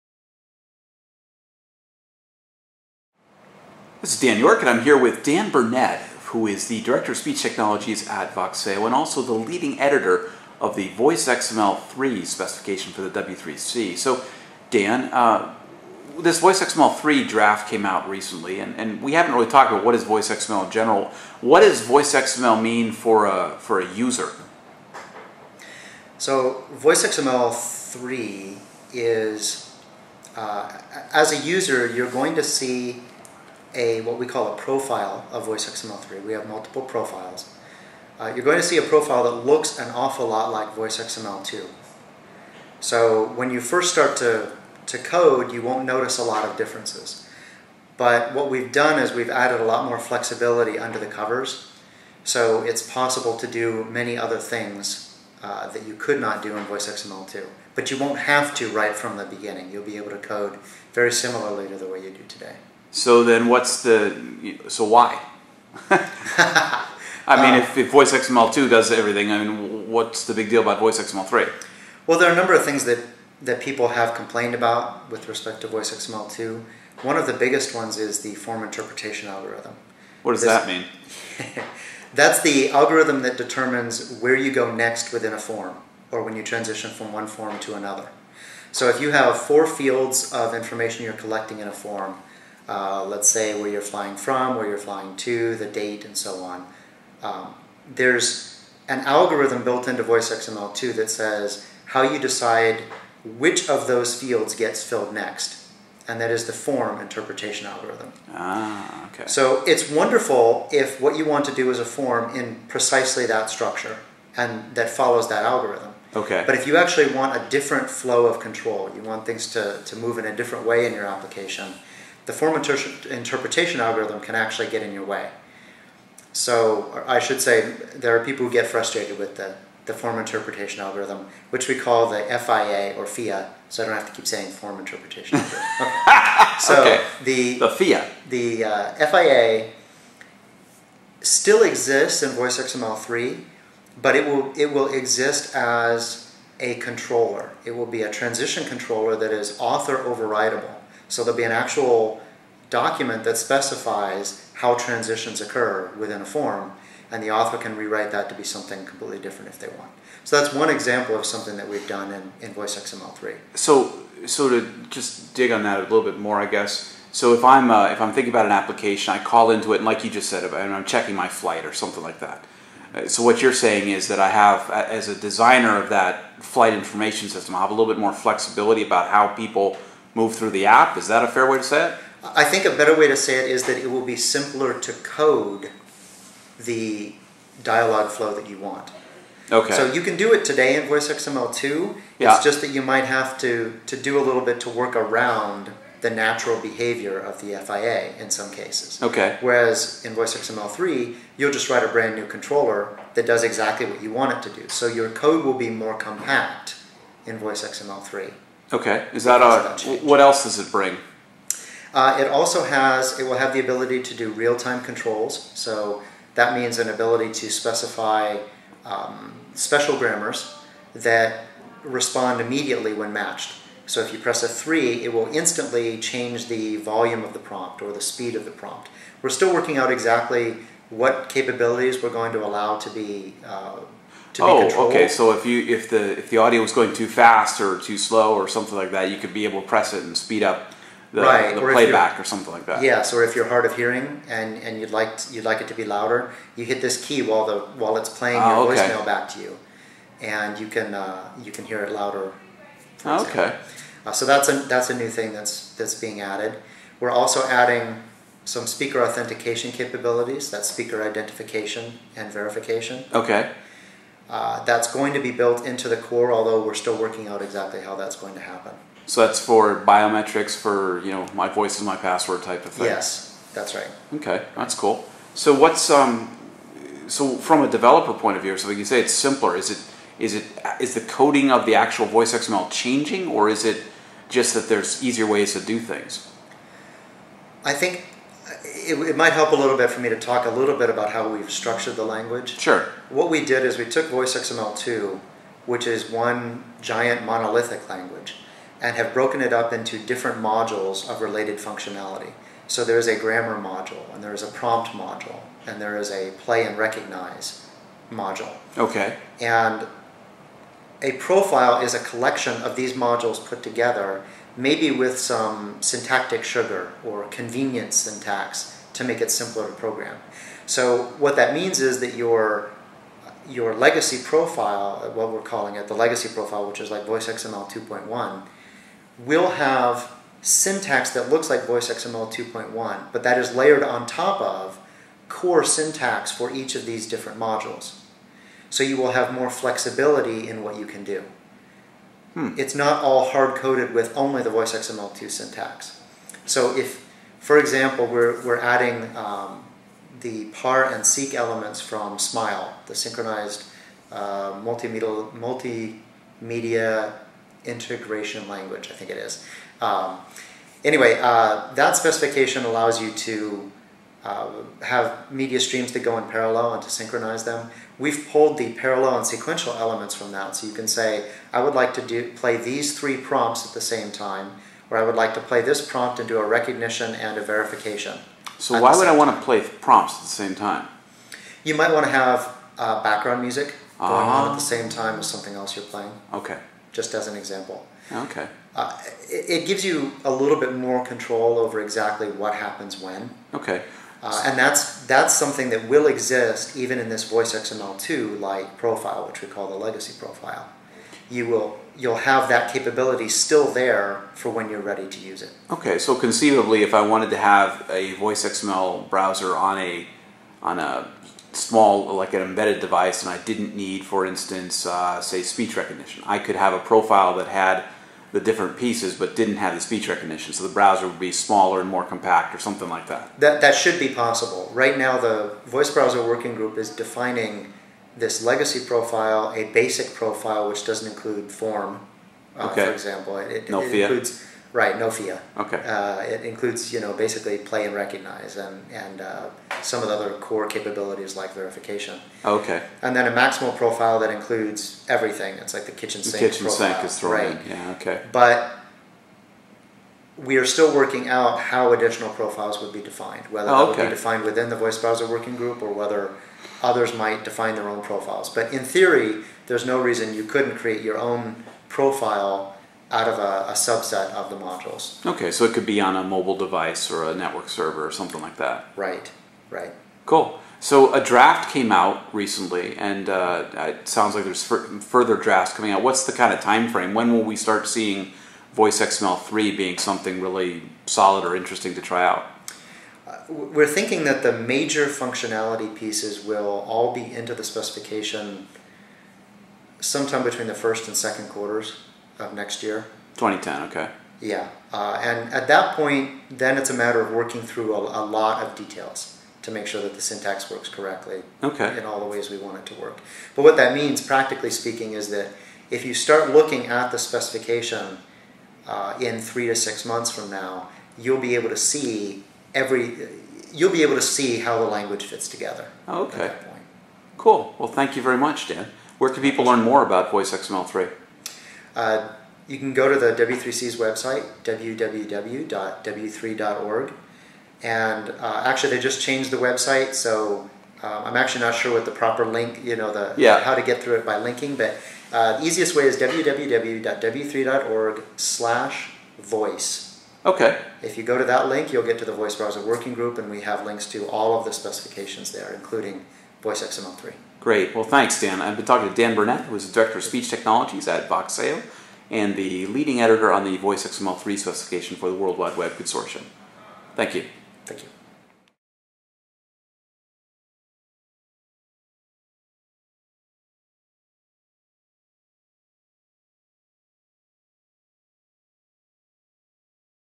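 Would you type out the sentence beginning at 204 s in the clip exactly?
So your code will be more compact in VoiceXML3.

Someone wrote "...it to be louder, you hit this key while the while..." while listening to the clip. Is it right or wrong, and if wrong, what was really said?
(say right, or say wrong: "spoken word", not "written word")
right.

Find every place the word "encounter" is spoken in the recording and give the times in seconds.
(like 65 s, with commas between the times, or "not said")
not said.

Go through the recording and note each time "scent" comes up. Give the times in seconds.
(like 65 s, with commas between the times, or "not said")
not said.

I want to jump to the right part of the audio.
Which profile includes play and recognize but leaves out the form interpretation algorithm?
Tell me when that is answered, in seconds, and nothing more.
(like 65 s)
429 s.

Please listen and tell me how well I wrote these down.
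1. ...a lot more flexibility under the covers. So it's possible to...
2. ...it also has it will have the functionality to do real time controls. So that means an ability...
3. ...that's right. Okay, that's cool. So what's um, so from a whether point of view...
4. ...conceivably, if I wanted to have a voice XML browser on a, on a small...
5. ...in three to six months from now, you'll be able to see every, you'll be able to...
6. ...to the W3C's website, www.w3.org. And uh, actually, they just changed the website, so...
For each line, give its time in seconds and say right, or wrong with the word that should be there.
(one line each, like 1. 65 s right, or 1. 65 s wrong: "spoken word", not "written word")
1. 49 s right
2. 212 s wrong: "ability", not "functionality"
3. 273 s wrong: "developer", not "whether"
4. 406 s right
5. 509 s right
6. 523 s right.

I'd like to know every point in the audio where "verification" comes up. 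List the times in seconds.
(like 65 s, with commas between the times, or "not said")
262 s, 377 s, 441 s.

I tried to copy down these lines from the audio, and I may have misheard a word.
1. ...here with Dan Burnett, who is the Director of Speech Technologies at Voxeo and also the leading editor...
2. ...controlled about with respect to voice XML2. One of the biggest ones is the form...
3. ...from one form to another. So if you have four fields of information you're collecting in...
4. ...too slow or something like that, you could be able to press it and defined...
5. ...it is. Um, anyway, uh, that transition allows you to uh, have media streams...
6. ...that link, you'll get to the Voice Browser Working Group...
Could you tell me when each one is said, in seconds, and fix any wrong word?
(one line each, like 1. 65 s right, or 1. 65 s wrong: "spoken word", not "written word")
1. 4 s right
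2. 74 s wrong: "complained", not "controlled"
3. 86 s right
4. 237 s wrong: "speed", not "defined"
5. 359 s wrong: "specification", not "transition"
6. 541 s right.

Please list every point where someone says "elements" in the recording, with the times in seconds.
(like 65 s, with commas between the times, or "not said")
351 s, 369 s.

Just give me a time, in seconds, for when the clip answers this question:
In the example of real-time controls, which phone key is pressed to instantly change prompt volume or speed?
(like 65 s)
224 s.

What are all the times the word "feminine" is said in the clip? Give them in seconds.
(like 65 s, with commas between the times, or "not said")
not said.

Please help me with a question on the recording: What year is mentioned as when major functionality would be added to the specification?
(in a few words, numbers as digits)
2010.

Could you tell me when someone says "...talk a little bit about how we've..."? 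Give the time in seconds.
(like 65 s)
290 s.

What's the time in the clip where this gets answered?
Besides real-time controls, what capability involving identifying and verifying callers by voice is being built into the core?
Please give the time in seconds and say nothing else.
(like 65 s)
258 s.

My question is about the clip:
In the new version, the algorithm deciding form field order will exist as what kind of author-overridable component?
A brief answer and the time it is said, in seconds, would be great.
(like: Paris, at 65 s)
transition controller, at 148 s.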